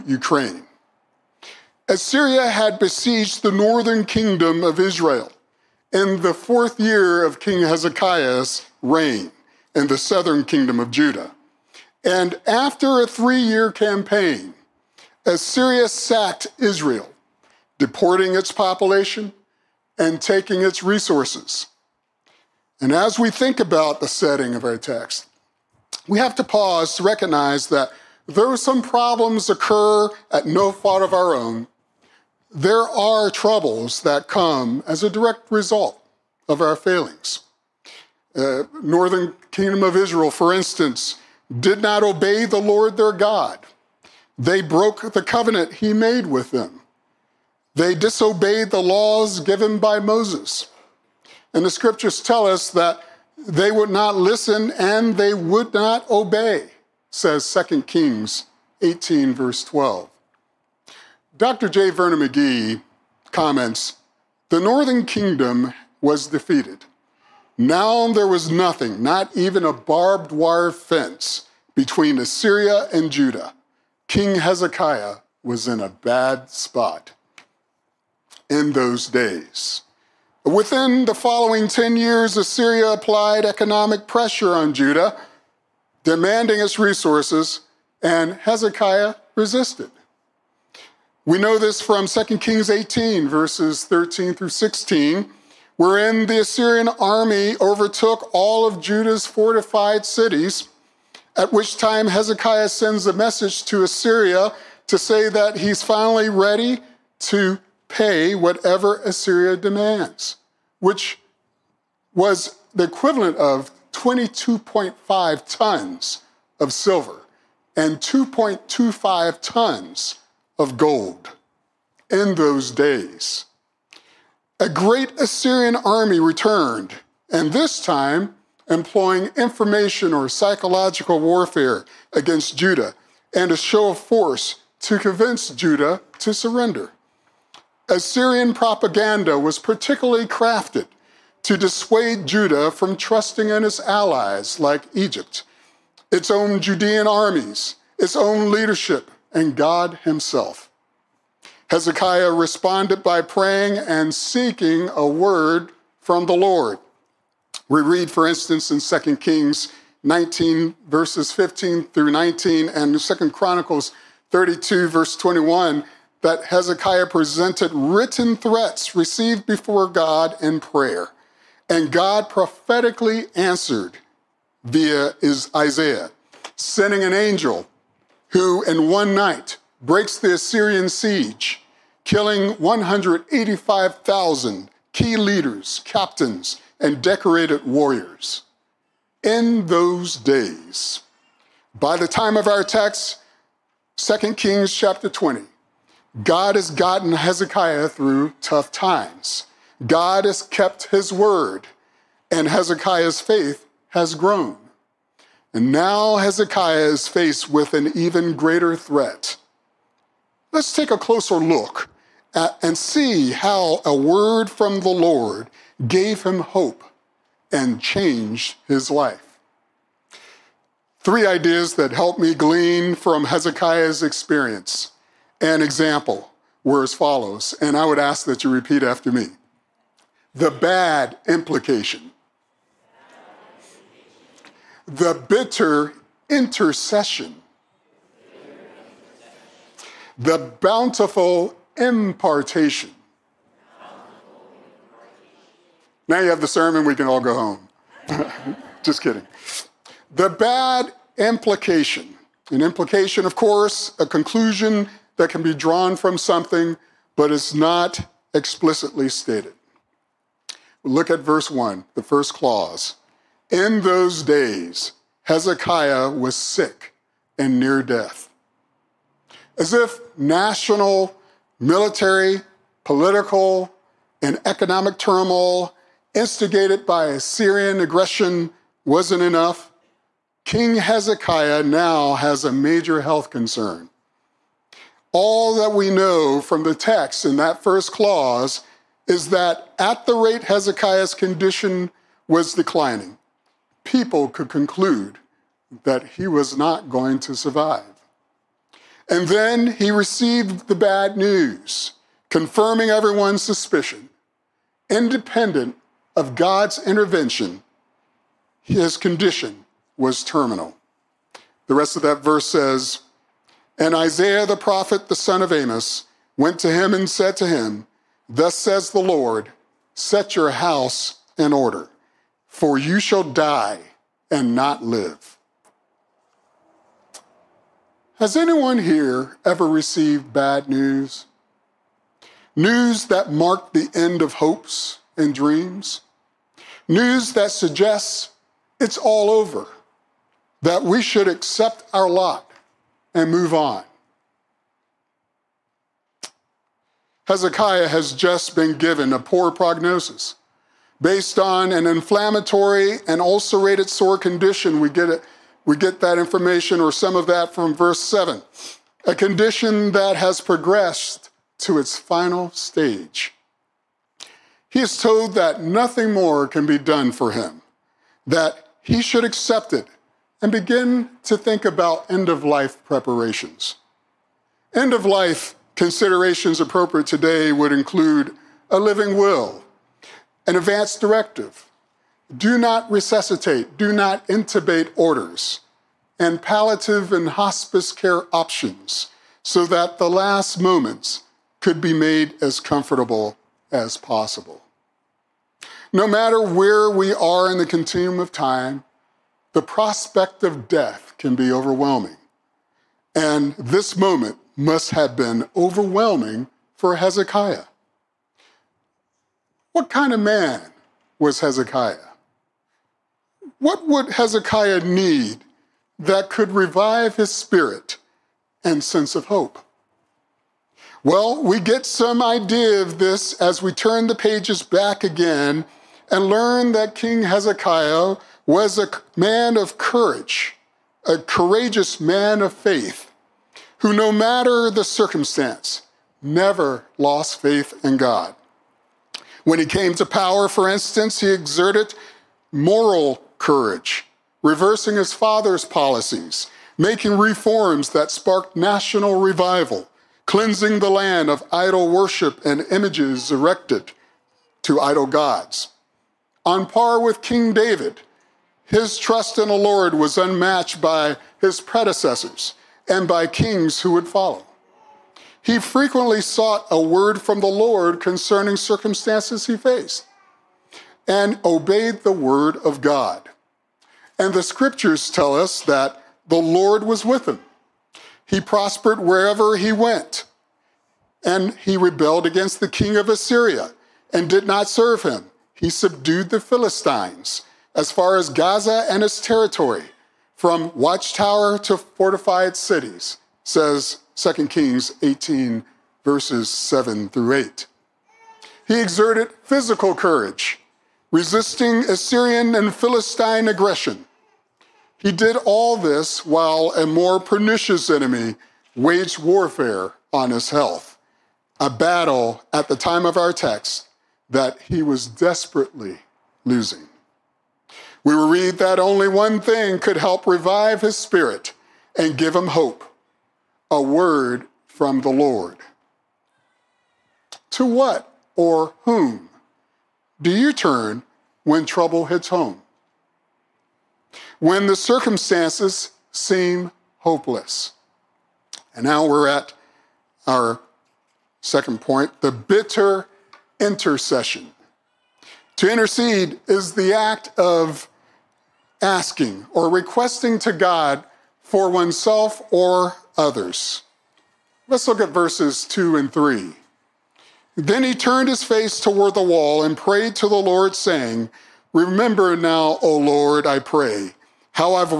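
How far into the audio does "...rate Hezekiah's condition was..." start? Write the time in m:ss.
4:50.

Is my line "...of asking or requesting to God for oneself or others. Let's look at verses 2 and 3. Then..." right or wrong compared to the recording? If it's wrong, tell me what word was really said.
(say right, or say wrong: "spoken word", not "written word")
right.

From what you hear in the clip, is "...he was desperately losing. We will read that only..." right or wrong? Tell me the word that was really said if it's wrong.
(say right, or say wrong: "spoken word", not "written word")
right.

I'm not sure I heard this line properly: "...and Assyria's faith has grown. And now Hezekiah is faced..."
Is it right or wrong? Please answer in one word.
wrong.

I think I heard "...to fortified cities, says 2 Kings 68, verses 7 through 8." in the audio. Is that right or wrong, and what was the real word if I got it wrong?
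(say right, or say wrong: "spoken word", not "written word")
wrong: "18", not "68".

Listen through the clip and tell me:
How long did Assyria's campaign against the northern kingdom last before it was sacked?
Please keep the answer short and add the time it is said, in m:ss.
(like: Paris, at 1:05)
3 years, at 0:13.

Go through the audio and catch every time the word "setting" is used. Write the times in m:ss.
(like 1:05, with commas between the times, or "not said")
0:24.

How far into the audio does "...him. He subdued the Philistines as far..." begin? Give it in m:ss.
8:05.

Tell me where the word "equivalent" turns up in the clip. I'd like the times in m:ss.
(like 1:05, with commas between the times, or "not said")
1:52.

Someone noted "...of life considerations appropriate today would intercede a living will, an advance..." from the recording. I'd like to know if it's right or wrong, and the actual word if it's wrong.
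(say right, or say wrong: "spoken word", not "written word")
wrong: "include", not "intercede".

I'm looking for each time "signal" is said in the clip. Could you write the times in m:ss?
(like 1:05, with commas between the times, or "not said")
not said.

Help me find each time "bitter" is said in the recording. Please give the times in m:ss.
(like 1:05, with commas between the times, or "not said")
3:55, 9:02.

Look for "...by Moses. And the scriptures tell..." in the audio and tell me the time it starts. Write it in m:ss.
0:49.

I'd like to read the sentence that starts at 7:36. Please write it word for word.
On par with King David, his trust in the Lord was unmatched by his predecessors and by kings who would follow.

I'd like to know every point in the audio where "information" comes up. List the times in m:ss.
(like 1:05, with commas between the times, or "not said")
2:09, 5:56.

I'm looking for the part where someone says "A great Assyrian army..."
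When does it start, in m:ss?
2:04.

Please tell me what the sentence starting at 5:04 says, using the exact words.
Independent of God's intervention, his condition was terminal.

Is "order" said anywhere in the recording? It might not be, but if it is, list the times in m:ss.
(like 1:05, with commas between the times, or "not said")
5:21, 6:24.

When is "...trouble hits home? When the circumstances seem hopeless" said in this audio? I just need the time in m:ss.
8:51.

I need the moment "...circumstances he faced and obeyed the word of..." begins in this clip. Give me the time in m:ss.
7:48.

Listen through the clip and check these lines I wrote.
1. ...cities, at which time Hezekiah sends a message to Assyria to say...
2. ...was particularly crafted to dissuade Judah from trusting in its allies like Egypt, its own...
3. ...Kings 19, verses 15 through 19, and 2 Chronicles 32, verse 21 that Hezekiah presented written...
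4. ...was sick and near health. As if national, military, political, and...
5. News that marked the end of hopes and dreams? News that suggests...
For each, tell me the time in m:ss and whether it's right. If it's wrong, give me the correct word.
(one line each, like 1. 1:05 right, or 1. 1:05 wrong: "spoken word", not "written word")
1. 1:40 right
2. 2:19 right
3. 2:39 right
4. 4:26 wrong: "death", not "health"
5. 5:32 right.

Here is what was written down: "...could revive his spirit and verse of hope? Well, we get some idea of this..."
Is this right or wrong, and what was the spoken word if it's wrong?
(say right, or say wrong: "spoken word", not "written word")
wrong: "sense", not "verse".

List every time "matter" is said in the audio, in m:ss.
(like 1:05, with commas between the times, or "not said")
6:36, 7:14.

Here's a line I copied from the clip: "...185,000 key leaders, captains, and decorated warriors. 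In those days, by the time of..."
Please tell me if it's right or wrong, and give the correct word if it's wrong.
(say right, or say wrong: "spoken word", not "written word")
right.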